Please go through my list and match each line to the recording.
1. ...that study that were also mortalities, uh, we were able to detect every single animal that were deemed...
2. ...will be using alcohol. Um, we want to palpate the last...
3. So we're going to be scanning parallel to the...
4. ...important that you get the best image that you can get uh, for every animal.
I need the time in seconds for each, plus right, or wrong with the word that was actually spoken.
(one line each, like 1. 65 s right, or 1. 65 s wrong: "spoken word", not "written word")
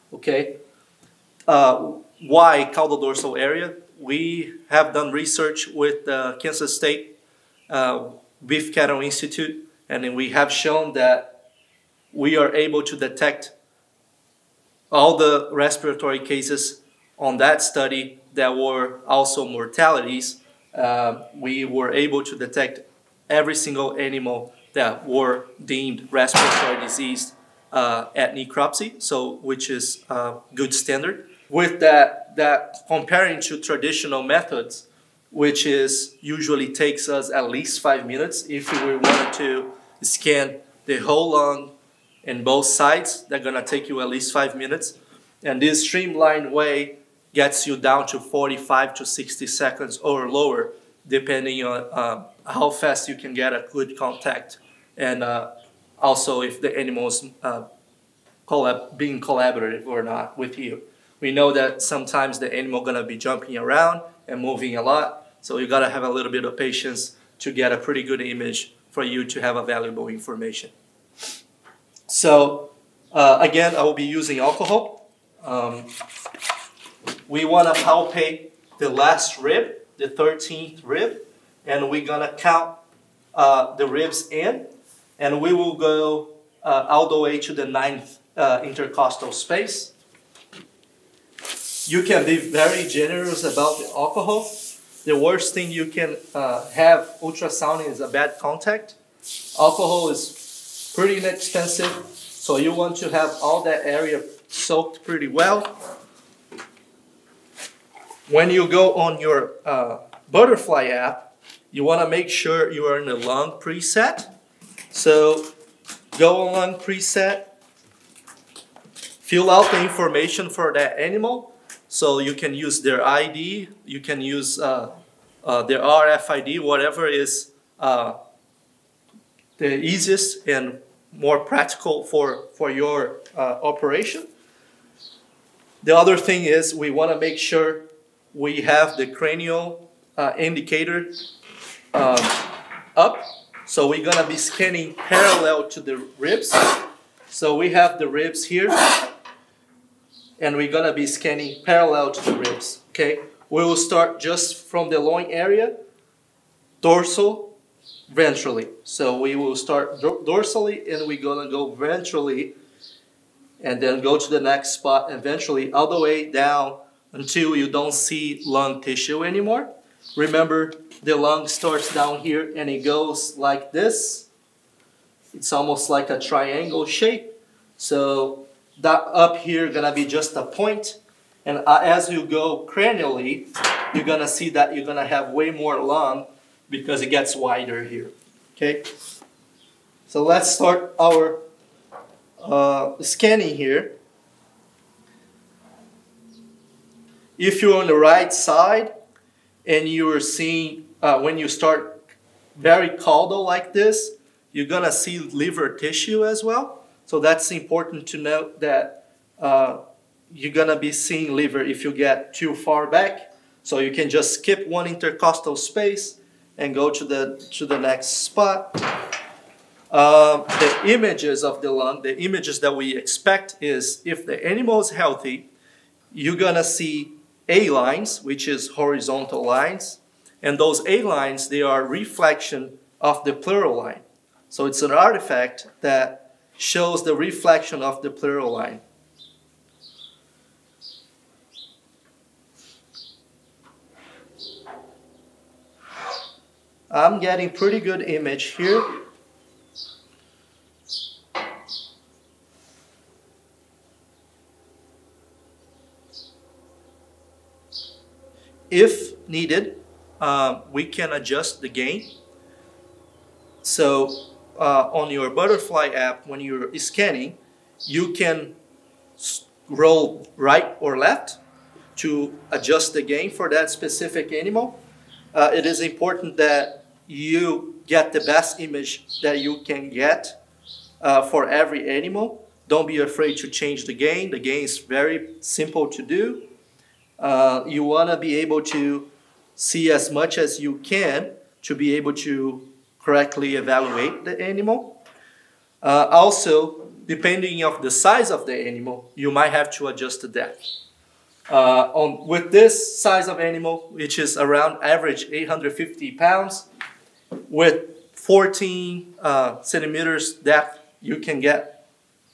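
1. 17 s right
2. 73 s right
3. 143 s right
4. 275 s right.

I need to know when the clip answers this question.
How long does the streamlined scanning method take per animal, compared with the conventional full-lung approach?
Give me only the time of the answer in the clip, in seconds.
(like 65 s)
48 s.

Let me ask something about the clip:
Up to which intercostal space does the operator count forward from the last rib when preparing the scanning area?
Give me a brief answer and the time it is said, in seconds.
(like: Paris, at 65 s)
ninth, at 87 s.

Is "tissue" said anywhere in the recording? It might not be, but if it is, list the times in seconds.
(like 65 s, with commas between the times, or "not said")
168 s, 205 s.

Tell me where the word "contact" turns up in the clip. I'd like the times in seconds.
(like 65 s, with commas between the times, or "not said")
53 s, 98 s.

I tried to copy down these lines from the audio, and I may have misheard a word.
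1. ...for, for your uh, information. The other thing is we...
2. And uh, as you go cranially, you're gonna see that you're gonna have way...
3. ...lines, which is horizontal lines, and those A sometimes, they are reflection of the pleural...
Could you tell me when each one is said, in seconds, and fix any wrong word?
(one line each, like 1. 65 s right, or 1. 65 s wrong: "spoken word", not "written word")
1. 132 s wrong: "operation", not "information"
2. 181 s right
3. 227 s wrong: "lines", not "sometimes".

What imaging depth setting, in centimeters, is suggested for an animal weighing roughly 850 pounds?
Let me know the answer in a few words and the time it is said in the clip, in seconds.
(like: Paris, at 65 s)
14, at 308 s.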